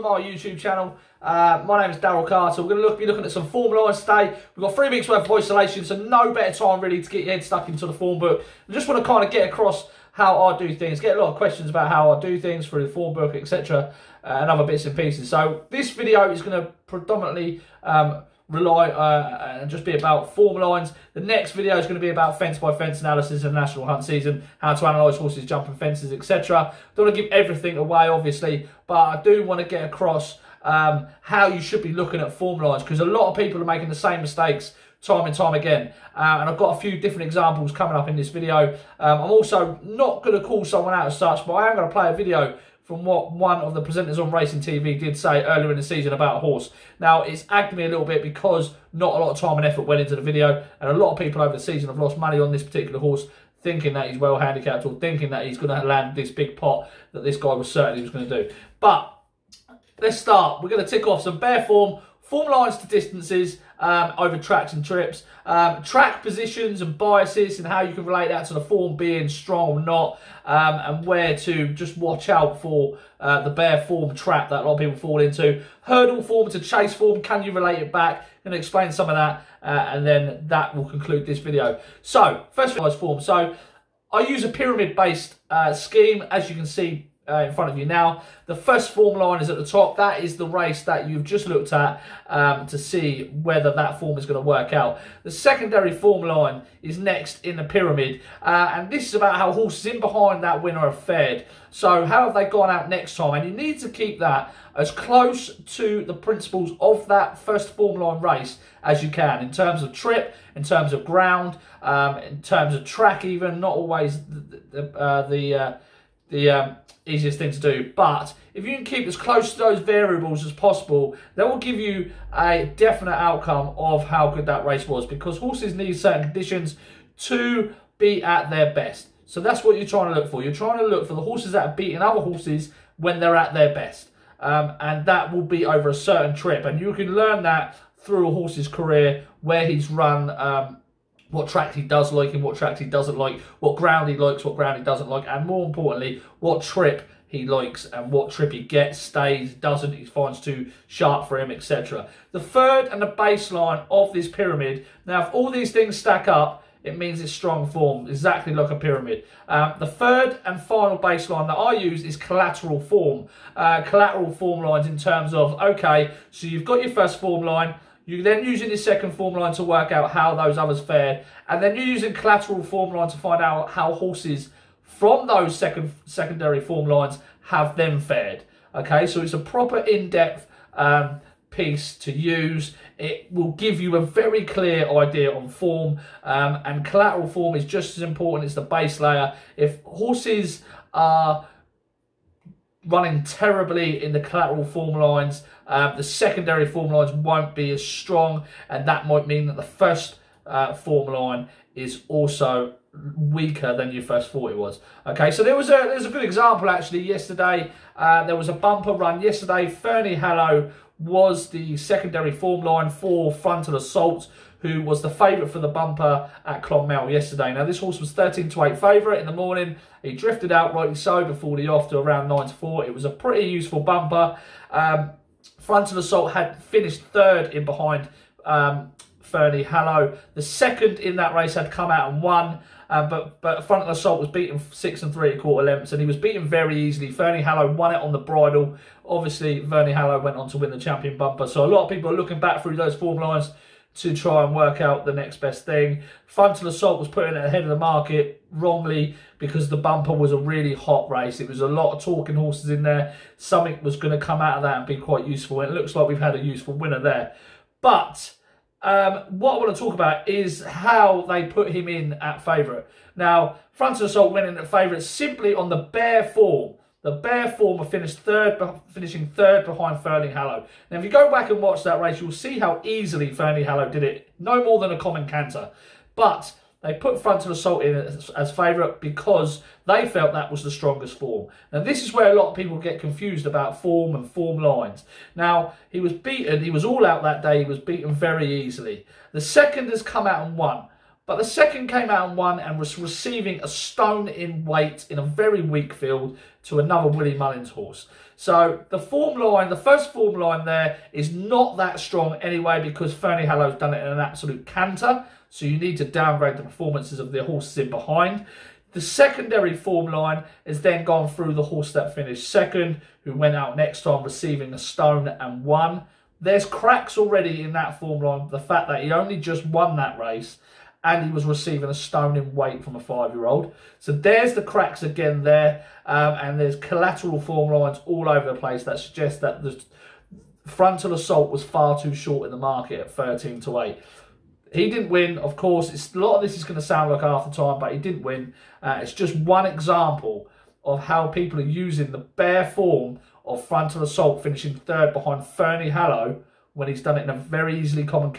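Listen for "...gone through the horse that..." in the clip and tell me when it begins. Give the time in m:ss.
5:11.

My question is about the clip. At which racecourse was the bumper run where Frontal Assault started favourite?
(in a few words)
Clonmel.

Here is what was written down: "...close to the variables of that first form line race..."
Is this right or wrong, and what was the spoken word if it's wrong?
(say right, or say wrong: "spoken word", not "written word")
wrong: "principles", not "variables".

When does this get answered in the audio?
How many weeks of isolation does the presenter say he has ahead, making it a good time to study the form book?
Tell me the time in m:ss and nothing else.
0:04.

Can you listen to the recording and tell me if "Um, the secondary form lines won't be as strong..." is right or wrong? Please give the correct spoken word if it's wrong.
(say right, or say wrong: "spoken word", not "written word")
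right.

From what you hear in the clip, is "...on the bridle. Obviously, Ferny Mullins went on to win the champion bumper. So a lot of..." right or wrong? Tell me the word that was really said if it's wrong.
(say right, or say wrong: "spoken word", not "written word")
wrong: "Hollow", not "Mullins".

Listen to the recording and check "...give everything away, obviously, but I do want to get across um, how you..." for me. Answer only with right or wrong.
right.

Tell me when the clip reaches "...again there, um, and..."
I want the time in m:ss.
5:25.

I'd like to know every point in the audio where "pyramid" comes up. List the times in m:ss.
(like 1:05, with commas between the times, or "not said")
1:24, 1:37, 2:34, 2:38.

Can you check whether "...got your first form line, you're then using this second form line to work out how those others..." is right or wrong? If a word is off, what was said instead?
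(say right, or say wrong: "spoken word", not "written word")
right.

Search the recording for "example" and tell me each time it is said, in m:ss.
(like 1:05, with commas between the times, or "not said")
0:37, 3:26, 5:39.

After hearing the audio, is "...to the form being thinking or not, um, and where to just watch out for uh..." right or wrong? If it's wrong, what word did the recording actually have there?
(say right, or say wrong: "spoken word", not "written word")
wrong: "strong", not "thinking".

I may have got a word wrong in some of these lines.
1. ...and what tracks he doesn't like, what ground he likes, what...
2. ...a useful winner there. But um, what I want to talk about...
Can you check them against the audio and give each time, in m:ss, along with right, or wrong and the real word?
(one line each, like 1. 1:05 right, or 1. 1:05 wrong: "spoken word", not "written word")
1. 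2:22 right
2. 4:16 right.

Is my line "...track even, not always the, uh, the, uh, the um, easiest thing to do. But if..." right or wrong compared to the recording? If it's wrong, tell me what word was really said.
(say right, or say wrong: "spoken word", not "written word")
right.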